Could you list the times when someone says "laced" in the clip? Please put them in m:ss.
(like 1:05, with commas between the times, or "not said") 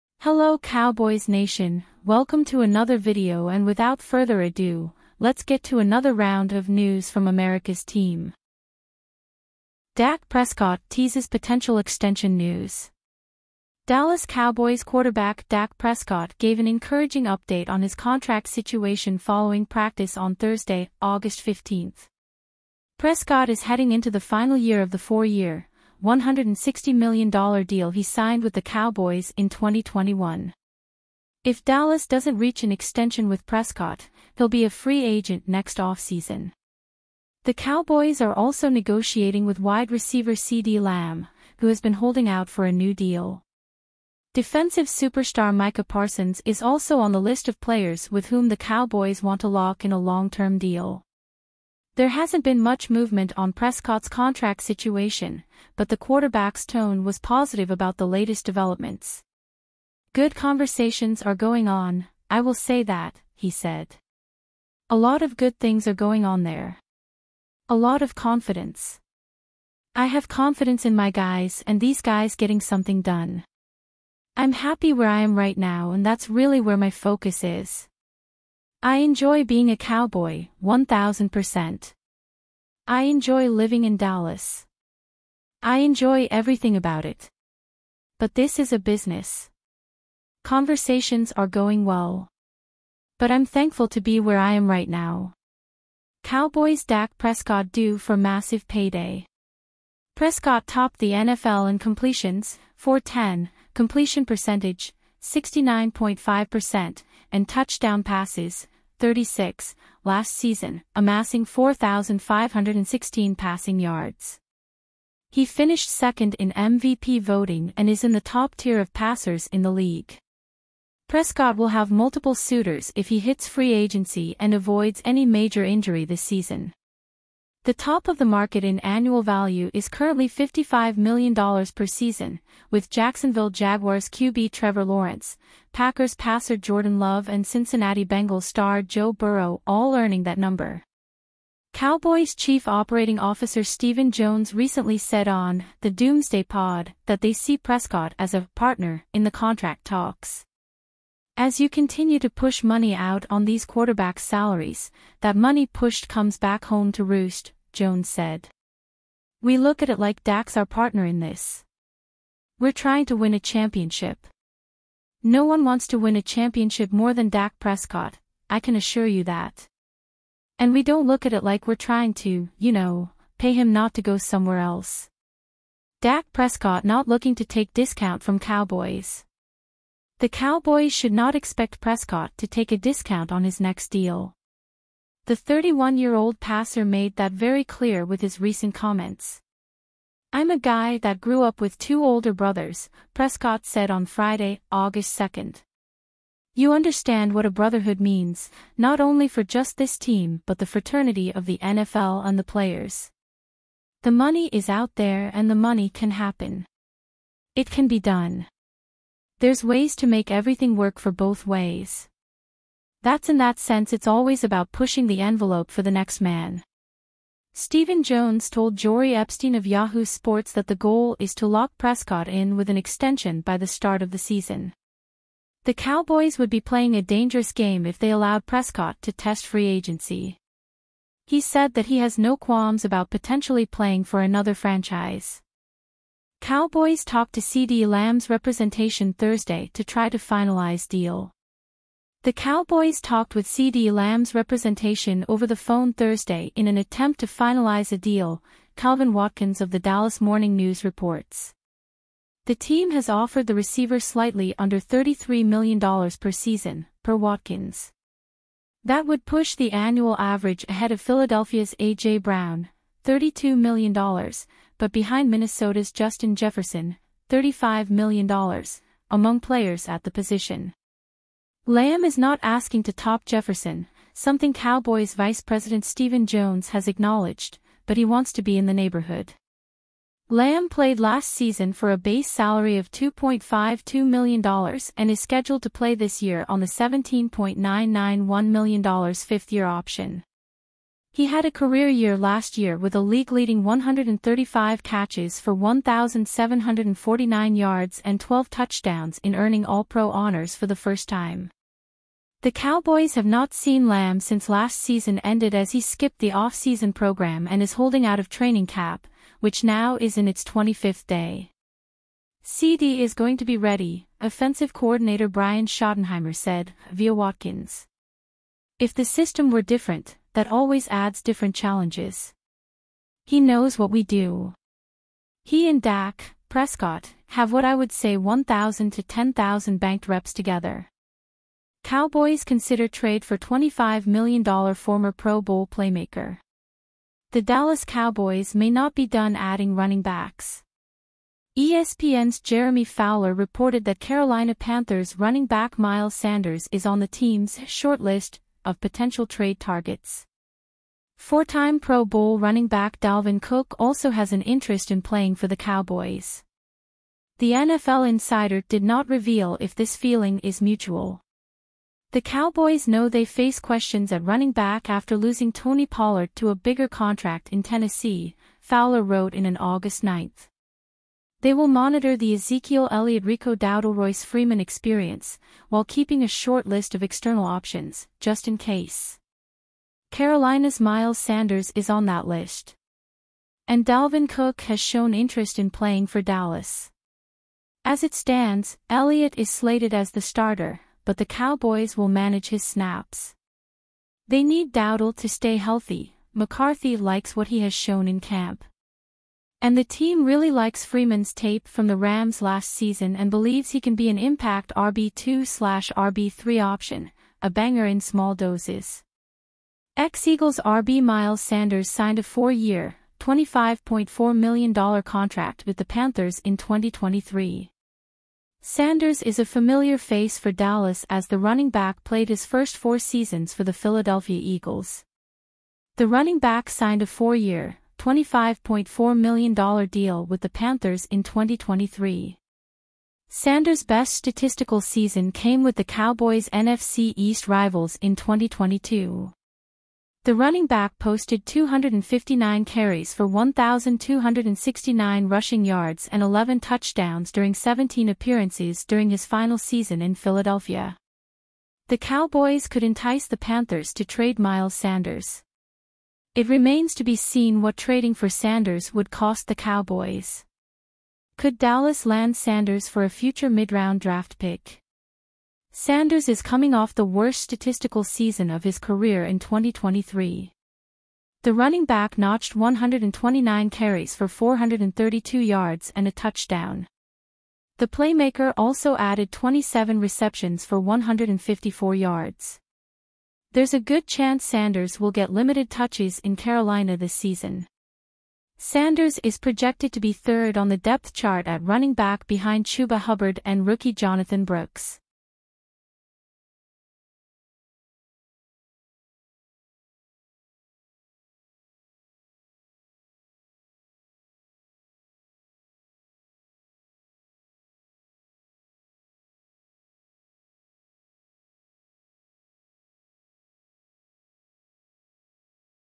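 not said.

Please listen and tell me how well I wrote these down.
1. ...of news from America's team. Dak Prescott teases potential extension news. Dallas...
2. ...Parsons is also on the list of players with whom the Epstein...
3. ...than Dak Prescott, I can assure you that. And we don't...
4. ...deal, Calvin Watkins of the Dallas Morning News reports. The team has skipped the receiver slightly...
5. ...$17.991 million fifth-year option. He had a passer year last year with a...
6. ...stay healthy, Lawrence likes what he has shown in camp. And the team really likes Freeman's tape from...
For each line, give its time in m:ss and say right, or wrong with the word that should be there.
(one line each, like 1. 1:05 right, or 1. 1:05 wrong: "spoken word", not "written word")
1. 0:06 right
2. 0:45 wrong: "Cowboys", not "Epstein"
3. 2:47 right
4. 4:07 wrong: "offered", not "skipped"
5. 4:46 wrong: "career", not "passer"
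6. 6:35 wrong: "McCarthy", not "Lawrence".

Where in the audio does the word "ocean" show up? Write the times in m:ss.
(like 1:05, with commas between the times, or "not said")
not said.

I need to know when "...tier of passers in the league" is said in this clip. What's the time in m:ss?
1:58.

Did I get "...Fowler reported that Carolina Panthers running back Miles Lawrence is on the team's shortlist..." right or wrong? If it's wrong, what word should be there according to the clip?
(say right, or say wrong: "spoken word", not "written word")
wrong: "Sanders", not "Lawrence".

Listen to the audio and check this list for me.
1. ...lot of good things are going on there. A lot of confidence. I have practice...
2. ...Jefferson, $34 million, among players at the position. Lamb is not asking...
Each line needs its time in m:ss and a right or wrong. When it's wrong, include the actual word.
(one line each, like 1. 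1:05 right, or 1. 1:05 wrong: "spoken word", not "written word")
1. 1:04 wrong: "confidence", not "practice"
2. 4:26 wrong: "35", not "34".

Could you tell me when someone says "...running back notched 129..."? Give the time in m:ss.
7:51.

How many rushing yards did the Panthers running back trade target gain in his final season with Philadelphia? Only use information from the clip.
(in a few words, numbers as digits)
1,269.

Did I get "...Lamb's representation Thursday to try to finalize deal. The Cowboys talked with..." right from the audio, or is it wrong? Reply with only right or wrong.
right.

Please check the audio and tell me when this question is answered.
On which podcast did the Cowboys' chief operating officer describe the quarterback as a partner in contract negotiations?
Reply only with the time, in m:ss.
2:25.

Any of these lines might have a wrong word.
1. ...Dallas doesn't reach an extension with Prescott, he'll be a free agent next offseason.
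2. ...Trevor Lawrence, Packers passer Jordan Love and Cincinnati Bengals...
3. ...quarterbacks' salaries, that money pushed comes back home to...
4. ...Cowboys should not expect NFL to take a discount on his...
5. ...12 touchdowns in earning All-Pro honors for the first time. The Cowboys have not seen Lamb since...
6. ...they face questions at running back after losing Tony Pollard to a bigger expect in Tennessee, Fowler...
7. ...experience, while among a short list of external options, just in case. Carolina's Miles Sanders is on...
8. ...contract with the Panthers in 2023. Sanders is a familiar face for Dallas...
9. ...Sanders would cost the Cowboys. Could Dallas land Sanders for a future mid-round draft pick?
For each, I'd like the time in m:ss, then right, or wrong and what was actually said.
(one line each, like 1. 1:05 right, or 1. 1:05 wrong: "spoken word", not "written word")
1. 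0:31 right
2. 2:14 right
3. 2:33 right
4. 3:00 wrong: "Prescott", not "NFL"
5. 4:58 right
6. 6:03 wrong: "contract", not "expect"
7. 6:14 wrong: "keeping", not "among"
8. 6:55 right
9. 7:38 right.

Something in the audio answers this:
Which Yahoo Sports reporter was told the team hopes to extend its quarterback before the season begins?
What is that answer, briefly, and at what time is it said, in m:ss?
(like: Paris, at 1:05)
Jori Epstein, at 3:38.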